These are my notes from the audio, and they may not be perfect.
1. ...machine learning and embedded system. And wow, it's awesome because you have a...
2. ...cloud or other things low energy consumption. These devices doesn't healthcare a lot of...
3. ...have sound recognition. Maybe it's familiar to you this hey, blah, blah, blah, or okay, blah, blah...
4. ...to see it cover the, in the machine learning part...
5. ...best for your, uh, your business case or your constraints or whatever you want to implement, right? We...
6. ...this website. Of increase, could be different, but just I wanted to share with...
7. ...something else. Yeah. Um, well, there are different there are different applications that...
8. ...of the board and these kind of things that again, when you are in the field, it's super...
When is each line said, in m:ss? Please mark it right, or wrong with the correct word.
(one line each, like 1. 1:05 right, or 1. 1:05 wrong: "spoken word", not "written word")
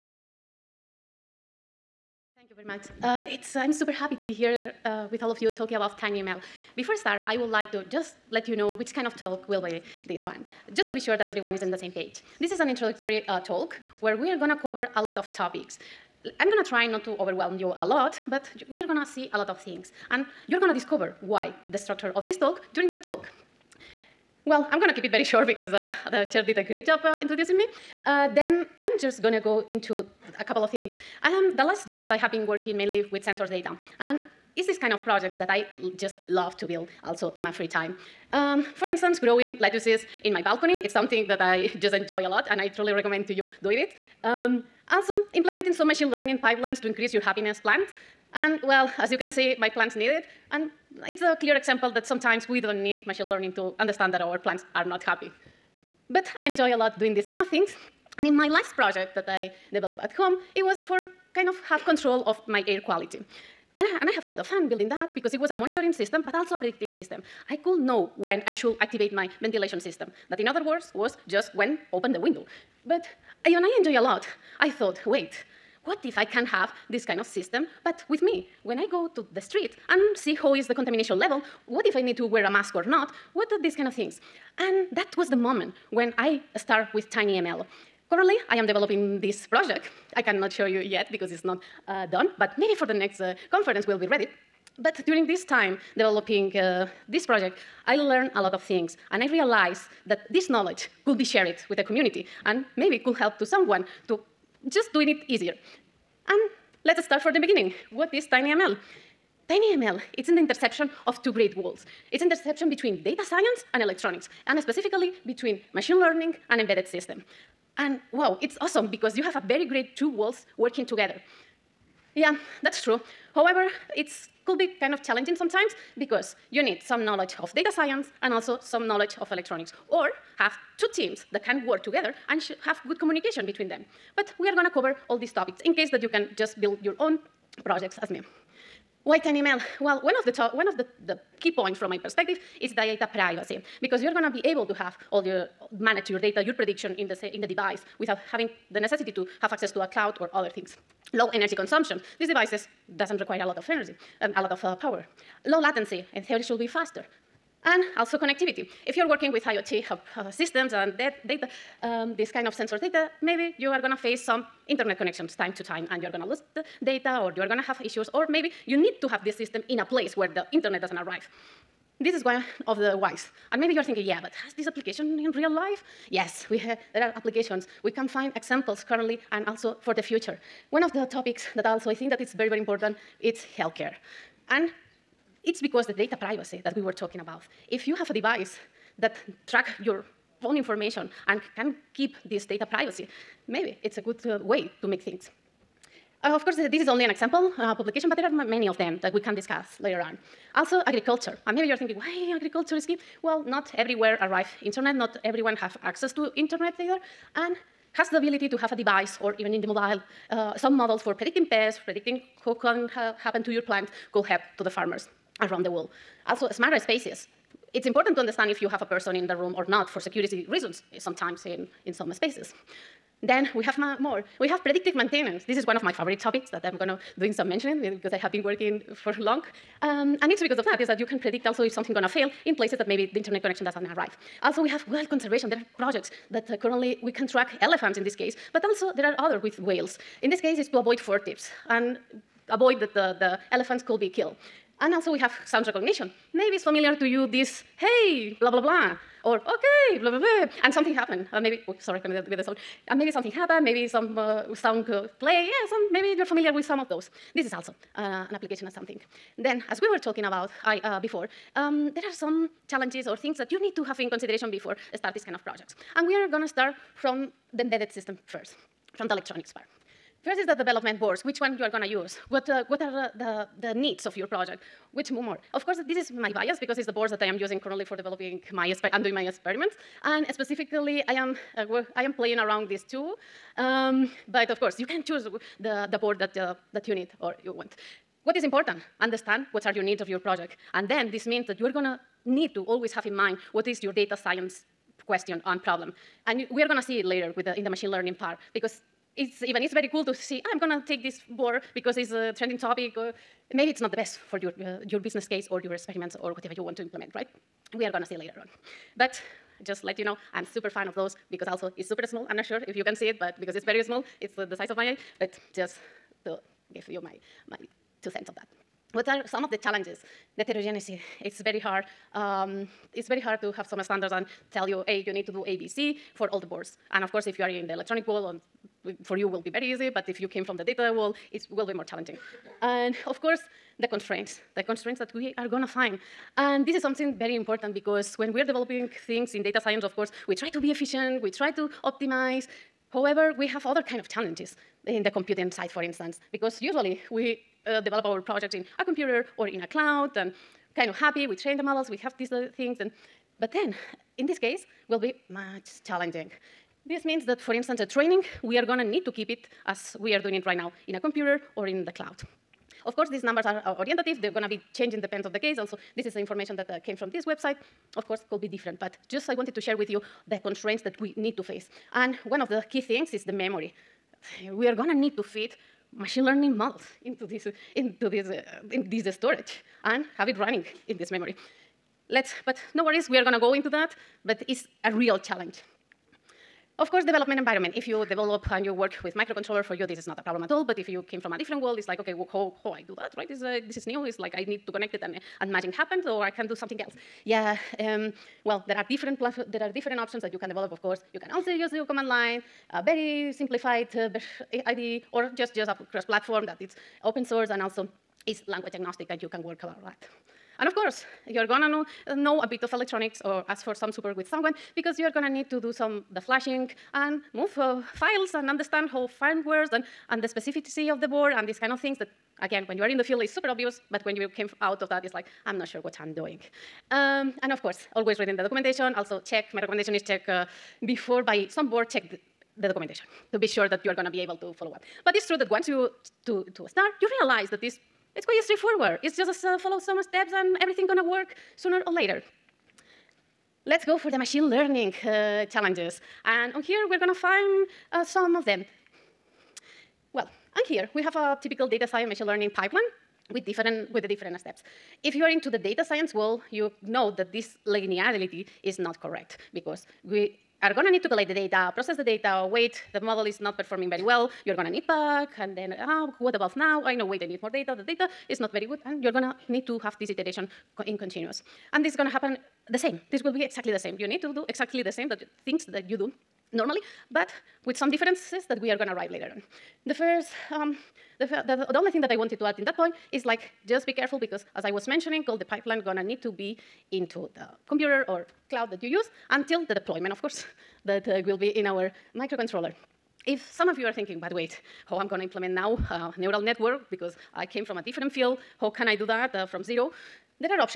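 1. 1:55 right
2. 2:29 wrong: "require", not "healthcare"
3. 4:05 right
4. 4:56 wrong: "later", not "cover"
5. 5:03 wrong: "experiments", not "constraints"
6. 6:07 wrong: "course", not "increase"
7. 6:36 wrong: "options", not "applications"
8. 7:00 right.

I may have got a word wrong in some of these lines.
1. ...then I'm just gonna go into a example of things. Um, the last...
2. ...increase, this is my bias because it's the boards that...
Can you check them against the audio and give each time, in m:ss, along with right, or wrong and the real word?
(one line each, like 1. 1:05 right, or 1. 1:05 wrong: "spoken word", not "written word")
1. 0:28 wrong: "couple", not "example"
2. 4:35 wrong: "course", not "increase".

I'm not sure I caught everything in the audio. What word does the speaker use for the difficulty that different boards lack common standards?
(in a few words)
Heterogeneity.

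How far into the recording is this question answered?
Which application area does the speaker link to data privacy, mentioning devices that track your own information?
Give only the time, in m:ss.
3:03.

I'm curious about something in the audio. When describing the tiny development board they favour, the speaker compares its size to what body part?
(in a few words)
Eye.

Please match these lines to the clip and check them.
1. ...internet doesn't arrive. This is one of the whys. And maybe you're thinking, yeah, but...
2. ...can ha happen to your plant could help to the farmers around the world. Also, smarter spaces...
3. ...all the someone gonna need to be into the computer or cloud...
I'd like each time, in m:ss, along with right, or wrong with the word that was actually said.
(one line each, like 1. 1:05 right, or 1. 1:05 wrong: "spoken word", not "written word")
1. 2:50 right
2. 3:32 right
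3. 8:05 wrong: "pipeline", not "someone".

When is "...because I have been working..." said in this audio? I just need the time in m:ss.
3:47.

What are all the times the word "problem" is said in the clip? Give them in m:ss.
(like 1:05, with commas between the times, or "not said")
4:55, 6:30.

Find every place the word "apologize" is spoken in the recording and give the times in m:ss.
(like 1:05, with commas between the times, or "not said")
not said.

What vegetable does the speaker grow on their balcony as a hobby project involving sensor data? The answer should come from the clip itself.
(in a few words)
Lettuces.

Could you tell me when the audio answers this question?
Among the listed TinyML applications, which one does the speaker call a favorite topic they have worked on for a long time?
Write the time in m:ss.
3:44.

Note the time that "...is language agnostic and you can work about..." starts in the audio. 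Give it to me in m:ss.
6:48.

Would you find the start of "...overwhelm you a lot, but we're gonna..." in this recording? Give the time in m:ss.
0:17.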